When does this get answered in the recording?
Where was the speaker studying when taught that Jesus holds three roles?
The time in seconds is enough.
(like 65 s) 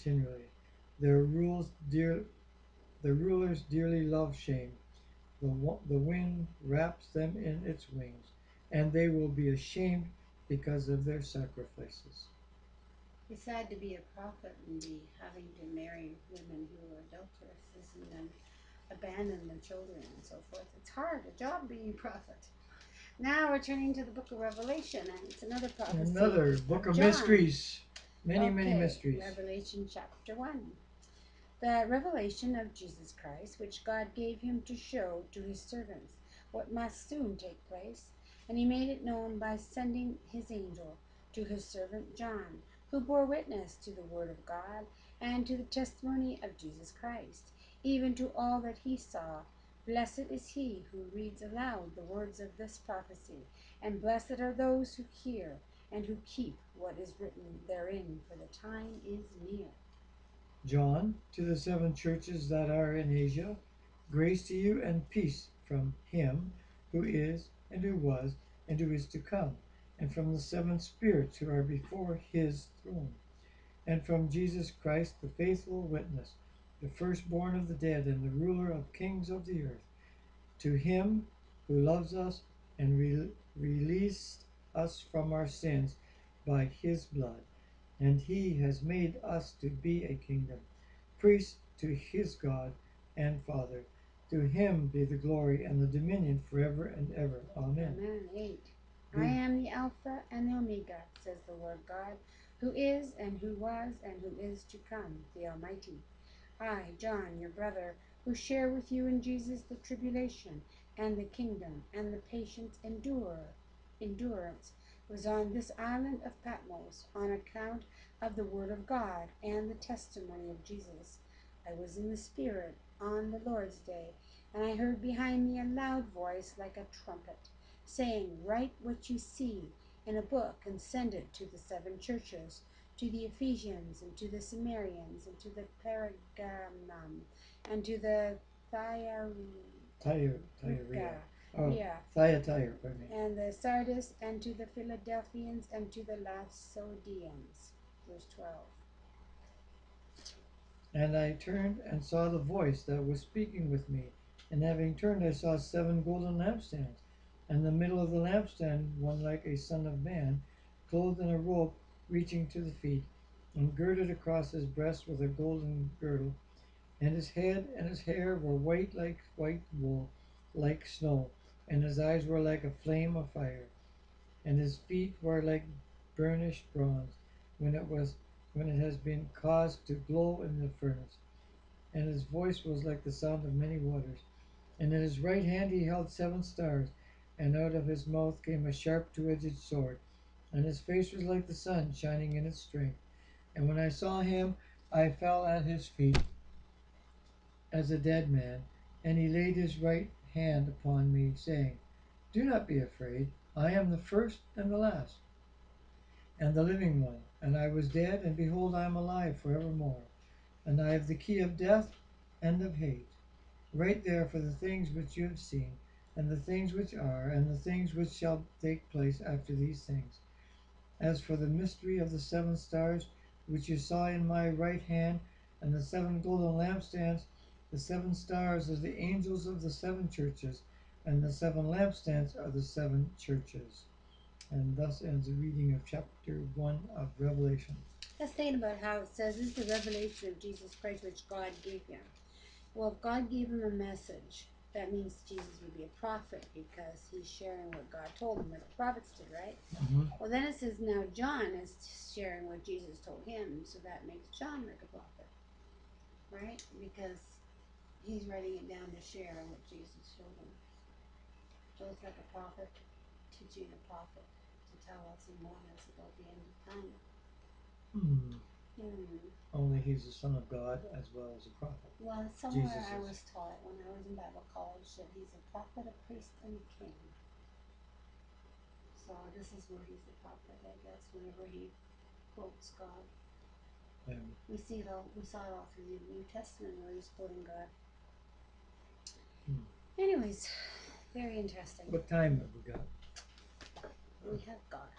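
274 s.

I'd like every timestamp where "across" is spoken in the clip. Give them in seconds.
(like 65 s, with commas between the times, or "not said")
164 s.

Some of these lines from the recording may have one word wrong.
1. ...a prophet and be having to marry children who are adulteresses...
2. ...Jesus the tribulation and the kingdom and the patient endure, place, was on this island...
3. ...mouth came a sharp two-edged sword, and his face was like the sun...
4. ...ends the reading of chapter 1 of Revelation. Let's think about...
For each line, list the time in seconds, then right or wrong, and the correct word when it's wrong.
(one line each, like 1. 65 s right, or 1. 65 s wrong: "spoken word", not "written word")
1. 13 s wrong: "women", not "children"
2. 109 s wrong: "endurance", not "place"
3. 188 s right
4. 235 s right.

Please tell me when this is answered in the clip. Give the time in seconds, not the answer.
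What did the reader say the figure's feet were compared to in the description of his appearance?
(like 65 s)
176 s.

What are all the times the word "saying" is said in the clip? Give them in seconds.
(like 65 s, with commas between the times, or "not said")
127 s, 201 s.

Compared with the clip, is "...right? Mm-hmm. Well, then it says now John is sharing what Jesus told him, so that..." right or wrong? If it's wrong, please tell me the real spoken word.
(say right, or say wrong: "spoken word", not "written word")
right.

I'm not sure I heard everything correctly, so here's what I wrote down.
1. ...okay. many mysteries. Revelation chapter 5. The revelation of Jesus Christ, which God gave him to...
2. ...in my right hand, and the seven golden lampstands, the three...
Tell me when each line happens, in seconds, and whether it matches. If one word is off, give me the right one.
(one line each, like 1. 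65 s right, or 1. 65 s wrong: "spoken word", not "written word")
1. 28 s wrong: "1", not "5"
2. 224 s wrong: "seven", not "three".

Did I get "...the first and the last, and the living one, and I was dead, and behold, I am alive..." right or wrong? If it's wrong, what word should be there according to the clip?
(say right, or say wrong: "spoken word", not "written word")
right.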